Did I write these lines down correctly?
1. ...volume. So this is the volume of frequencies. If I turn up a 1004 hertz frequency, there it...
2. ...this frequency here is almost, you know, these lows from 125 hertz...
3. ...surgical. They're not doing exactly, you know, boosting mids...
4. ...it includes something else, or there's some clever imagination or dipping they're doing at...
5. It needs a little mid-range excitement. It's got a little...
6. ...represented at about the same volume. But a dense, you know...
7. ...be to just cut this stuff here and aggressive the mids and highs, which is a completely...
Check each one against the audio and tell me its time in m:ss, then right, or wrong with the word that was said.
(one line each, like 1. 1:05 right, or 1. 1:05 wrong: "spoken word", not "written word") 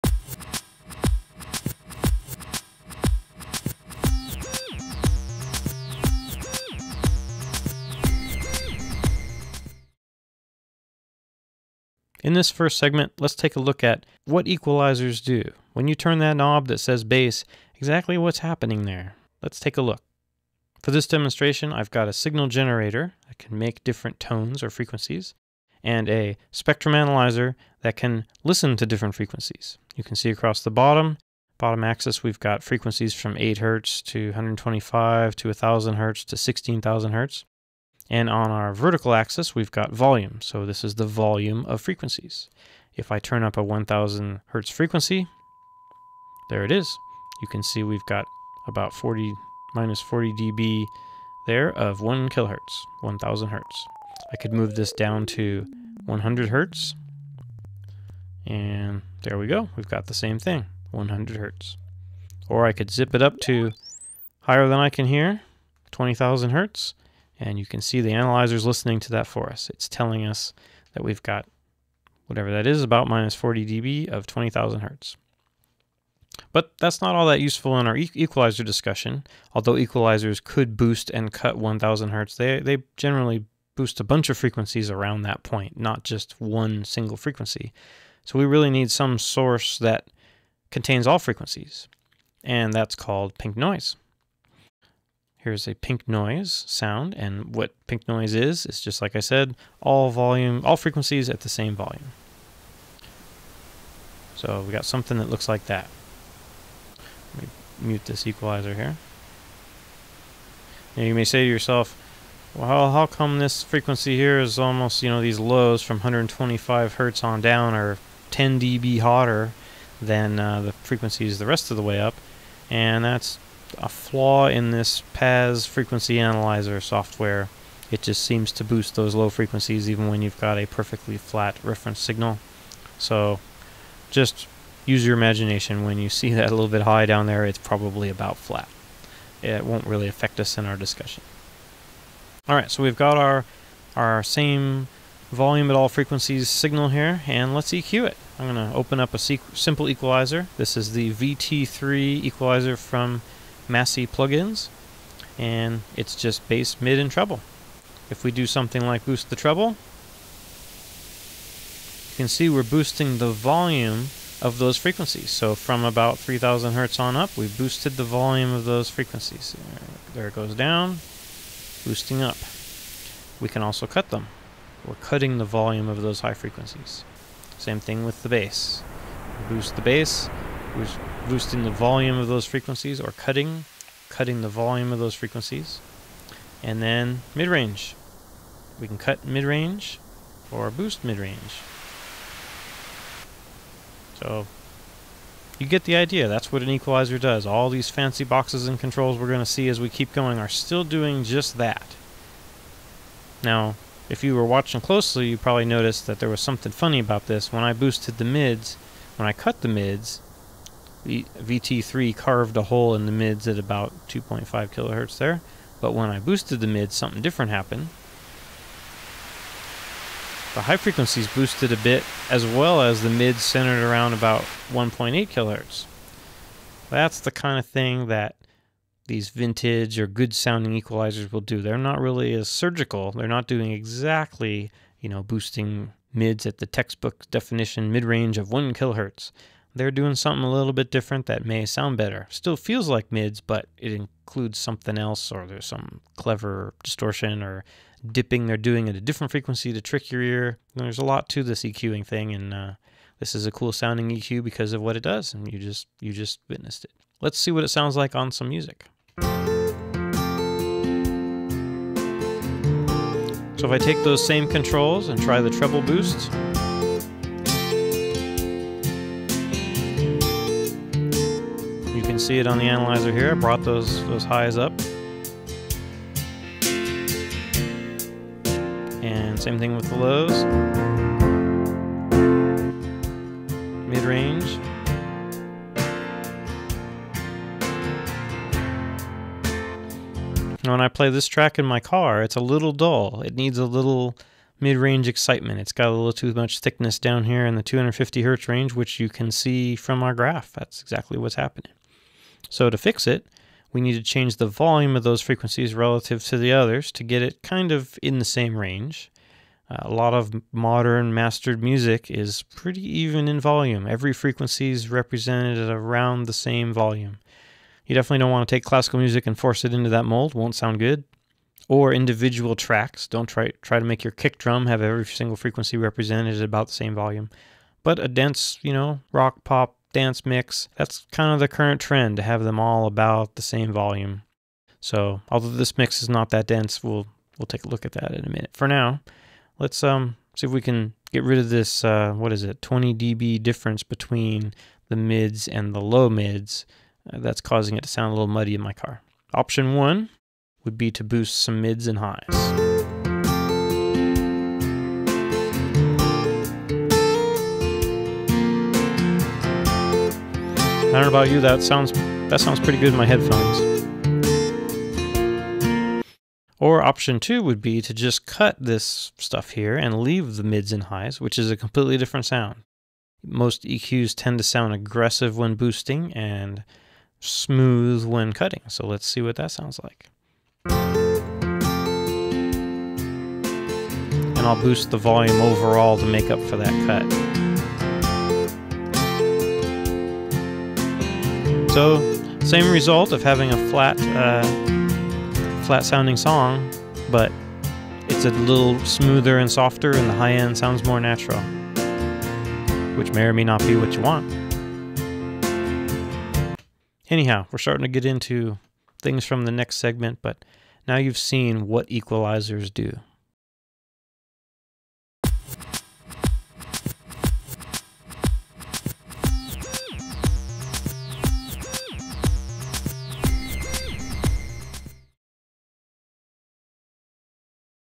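1. 0:39 wrong: "1000", not "1004"
2. 1:53 right
3. 3:52 right
4. 4:03 wrong: "distortion", not "imagination"
5. 4:53 right
6. 5:25 right
7. 6:07 wrong: "leave", not "aggressive".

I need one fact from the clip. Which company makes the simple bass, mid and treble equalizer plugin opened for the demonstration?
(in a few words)
Massey plugins.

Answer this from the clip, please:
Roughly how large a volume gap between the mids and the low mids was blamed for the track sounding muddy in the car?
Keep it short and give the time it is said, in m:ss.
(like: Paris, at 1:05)
20 dB, at 5:42.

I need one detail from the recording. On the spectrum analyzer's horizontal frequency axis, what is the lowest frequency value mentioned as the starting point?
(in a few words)
8 hertz.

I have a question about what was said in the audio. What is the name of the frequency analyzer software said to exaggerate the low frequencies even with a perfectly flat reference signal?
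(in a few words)
PAZ.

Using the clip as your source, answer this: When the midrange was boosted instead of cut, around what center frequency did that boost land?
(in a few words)
1.8 kilohertz.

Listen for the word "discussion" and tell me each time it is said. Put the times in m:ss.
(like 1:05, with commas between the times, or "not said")
1:18, 2:20.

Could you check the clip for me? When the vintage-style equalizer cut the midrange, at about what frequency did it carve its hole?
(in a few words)
2.5 kilohertz.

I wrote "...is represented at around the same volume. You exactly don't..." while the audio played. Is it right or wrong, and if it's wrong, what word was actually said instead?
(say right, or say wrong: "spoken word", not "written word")
wrong: "definitely", not "exactly".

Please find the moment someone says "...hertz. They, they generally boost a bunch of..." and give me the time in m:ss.
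1:22.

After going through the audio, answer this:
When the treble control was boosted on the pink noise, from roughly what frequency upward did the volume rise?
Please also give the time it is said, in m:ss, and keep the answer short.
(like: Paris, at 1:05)
3000 hertz, at 2:46.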